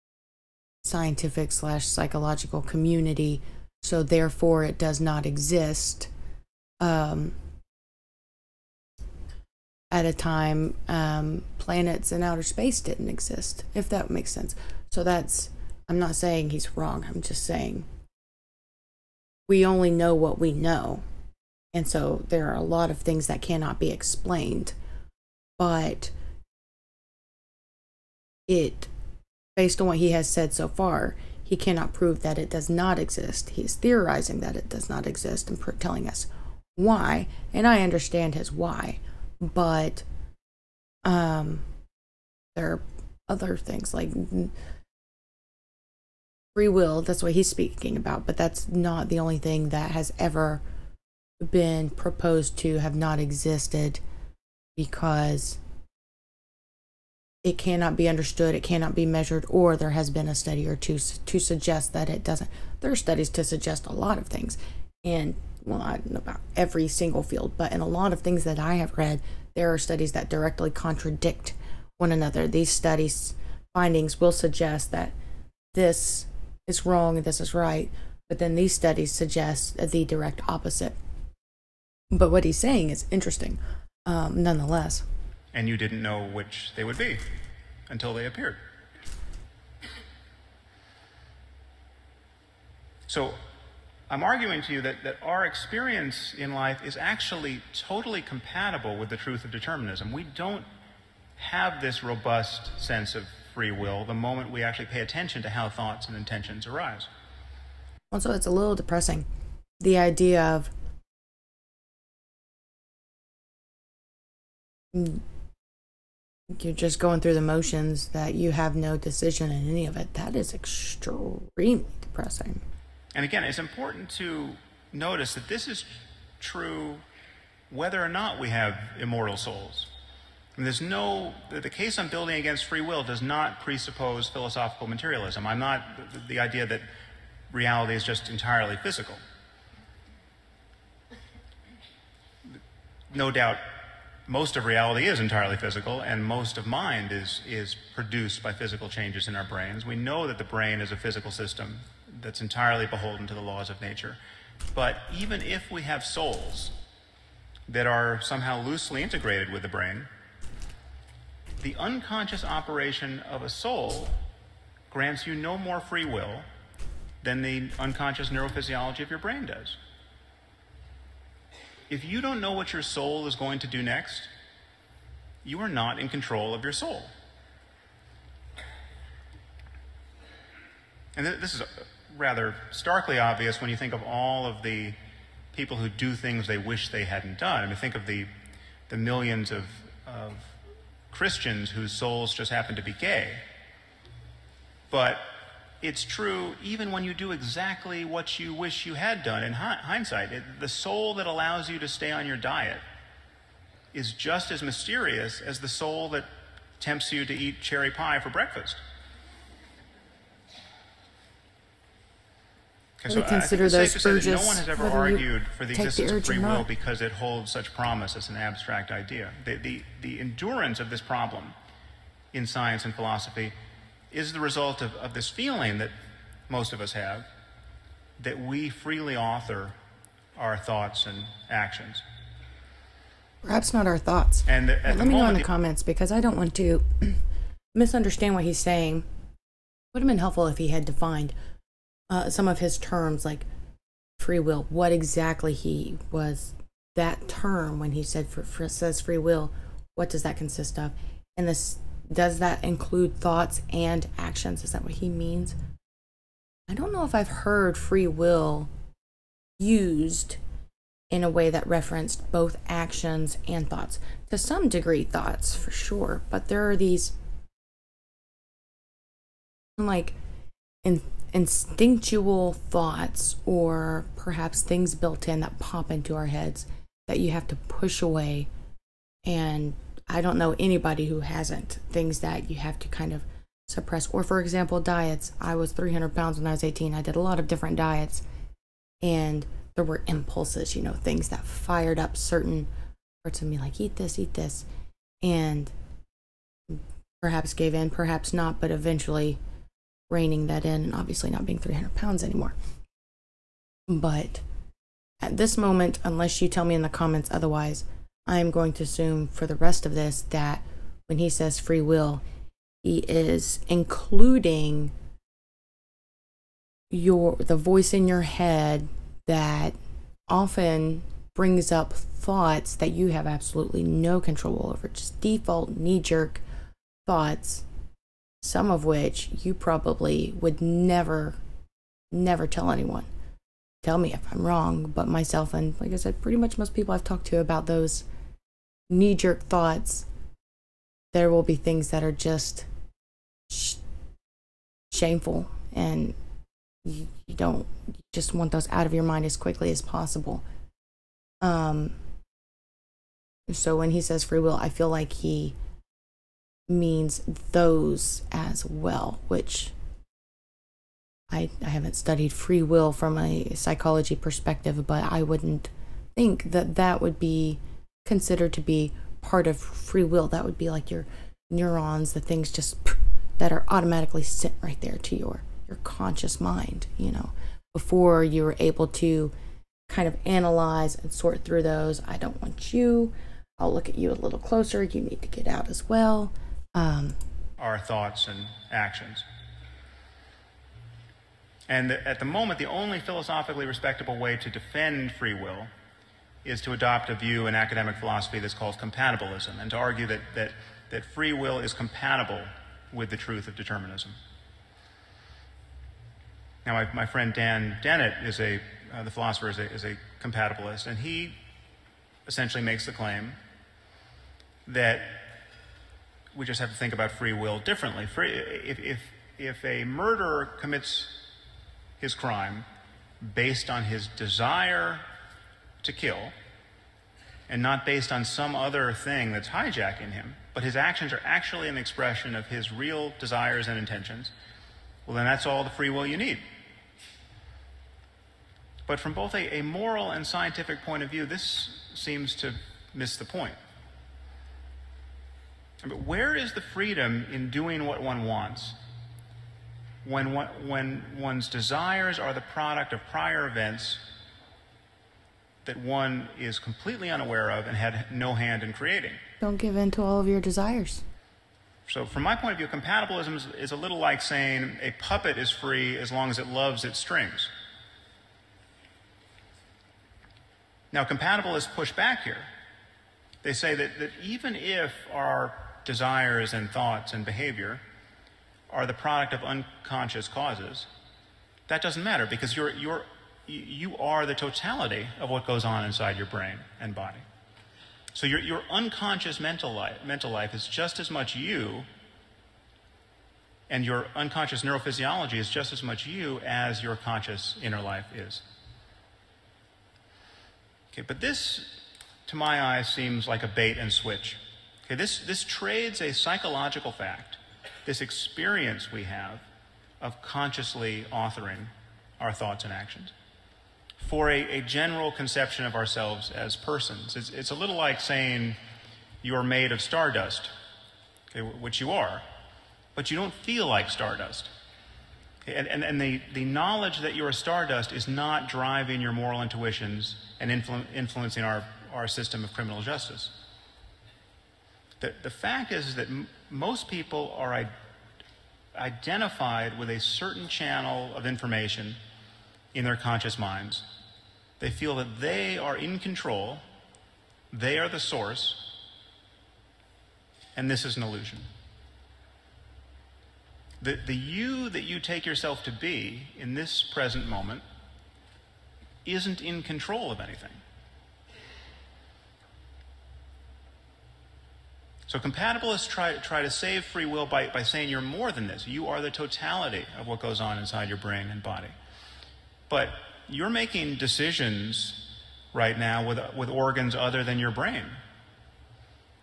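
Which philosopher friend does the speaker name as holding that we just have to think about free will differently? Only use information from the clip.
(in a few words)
Dan Dennett.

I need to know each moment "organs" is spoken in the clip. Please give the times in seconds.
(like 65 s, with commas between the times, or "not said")
576 s.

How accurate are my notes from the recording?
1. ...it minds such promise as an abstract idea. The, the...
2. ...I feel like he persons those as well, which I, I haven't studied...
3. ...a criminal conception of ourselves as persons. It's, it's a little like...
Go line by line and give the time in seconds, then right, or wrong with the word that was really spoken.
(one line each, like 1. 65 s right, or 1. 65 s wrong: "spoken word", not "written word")
1. 217 s wrong: "holds", not "minds"
2. 354 s wrong: "means", not "persons"
3. 514 s wrong: "general", not "criminal".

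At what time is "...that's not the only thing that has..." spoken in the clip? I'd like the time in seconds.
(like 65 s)
48 s.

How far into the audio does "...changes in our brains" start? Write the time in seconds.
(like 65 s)
148 s.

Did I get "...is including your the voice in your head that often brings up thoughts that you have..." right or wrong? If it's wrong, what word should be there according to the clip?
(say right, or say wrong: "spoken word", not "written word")
right.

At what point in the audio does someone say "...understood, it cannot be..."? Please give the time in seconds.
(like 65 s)
58 s.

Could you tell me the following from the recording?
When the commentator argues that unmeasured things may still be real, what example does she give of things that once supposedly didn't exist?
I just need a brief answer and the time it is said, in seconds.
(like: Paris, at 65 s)
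Planets in outer space, at 11 s.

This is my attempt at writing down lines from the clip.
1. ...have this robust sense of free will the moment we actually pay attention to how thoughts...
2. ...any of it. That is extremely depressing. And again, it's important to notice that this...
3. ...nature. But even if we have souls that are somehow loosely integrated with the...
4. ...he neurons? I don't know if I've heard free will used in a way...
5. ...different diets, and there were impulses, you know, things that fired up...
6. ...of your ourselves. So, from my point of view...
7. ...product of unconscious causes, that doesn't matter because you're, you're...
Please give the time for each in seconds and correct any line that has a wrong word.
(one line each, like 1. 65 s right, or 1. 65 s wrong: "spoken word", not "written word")
1. 101 s right
2. 119 s right
3. 153 s right
4. 254 s wrong: "means", not "neurons"
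5. 287 s right
6. 460 s wrong: "desires", not "ourselves"
7. 478 s right.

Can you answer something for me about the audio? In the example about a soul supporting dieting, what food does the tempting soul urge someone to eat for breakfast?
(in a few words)
Cherry pie.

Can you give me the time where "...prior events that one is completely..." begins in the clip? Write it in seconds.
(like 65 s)
453 s.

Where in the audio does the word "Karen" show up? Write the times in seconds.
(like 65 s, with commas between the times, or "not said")
not said.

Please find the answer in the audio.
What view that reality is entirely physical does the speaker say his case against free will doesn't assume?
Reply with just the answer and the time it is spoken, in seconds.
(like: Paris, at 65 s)
Philosophical materialism, at 134 s.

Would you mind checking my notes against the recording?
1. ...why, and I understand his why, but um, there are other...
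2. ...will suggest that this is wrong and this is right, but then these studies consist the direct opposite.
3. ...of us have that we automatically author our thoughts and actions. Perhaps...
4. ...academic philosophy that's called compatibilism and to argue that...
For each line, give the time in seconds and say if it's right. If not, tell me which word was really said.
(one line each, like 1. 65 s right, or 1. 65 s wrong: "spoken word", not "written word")
1. 36 s right
2. 74 s wrong: "suggest", not "consist"
3. 226 s wrong: "freely", not "automatically"
4. 397 s right.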